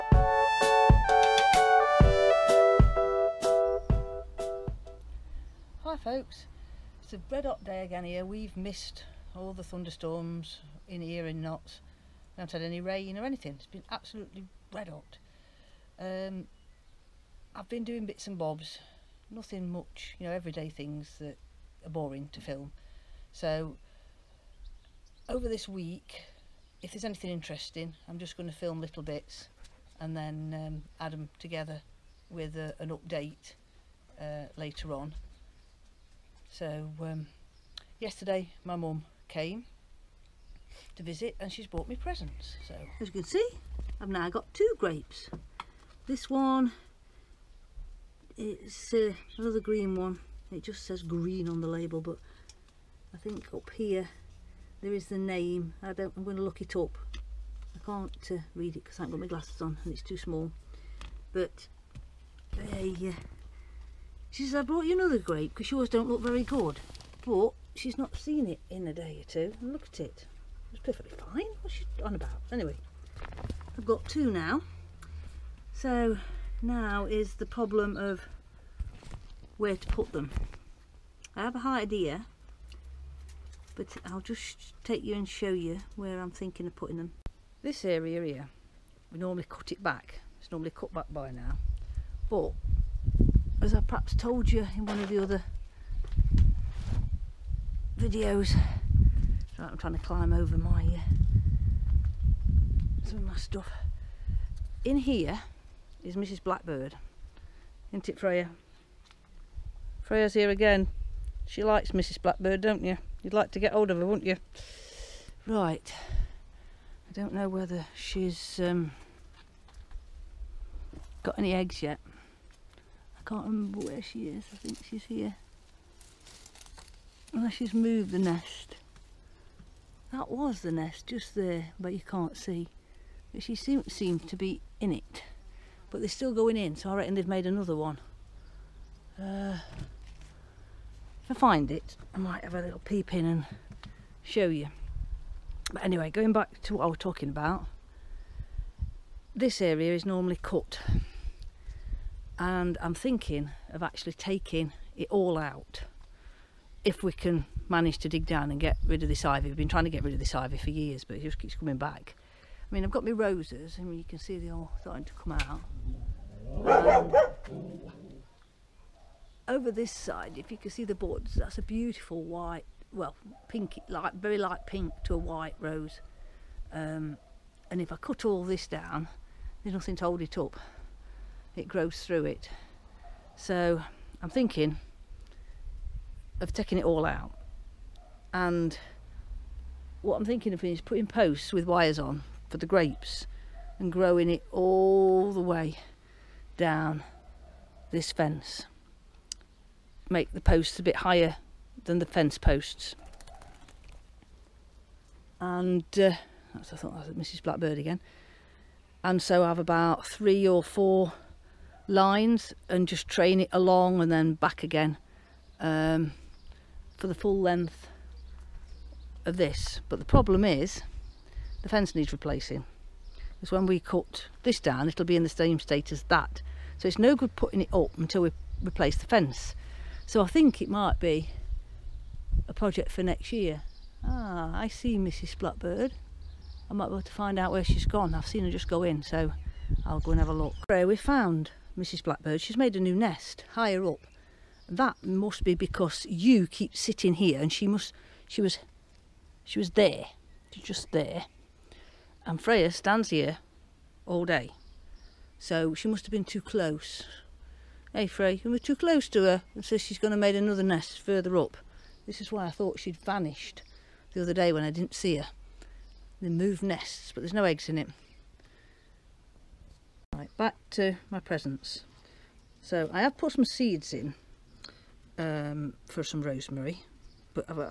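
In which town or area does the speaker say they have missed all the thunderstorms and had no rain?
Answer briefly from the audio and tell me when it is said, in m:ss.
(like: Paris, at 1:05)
Notts, at 0:11.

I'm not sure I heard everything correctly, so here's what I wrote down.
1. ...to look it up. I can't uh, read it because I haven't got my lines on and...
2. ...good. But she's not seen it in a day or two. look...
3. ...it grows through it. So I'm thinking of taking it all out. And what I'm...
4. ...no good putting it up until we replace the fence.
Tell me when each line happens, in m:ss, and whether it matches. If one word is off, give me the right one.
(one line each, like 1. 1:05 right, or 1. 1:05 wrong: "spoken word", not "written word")
1. 0:56 wrong: "glasses", not "lines"
2. 1:06 right
3. 3:01 right
4. 3:46 right.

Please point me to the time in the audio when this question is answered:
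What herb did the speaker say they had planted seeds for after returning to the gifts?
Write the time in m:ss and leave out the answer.
4:36.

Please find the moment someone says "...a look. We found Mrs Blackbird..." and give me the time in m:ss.
4:00.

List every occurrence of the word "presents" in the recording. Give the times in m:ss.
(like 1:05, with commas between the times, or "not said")
0:41, 4:31.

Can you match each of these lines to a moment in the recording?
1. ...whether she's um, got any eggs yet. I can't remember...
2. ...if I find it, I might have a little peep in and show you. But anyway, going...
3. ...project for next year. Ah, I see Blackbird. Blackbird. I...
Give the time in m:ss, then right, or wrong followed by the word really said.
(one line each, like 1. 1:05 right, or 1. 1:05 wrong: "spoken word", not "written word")
1. 1:57 right
2. 2:21 right
3. 3:52 wrong: "Mrs", not "Blackbird".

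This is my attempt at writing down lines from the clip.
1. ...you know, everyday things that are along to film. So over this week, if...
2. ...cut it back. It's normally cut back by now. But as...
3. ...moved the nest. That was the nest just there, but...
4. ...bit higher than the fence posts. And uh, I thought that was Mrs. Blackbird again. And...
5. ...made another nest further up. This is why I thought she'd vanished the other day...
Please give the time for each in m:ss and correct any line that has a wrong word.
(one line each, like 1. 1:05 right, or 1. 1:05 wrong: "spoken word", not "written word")
1. 0:20 wrong: "boring", not "along"
2. 1:29 right
3. 2:07 right
4. 3:20 right
5. 4:20 right.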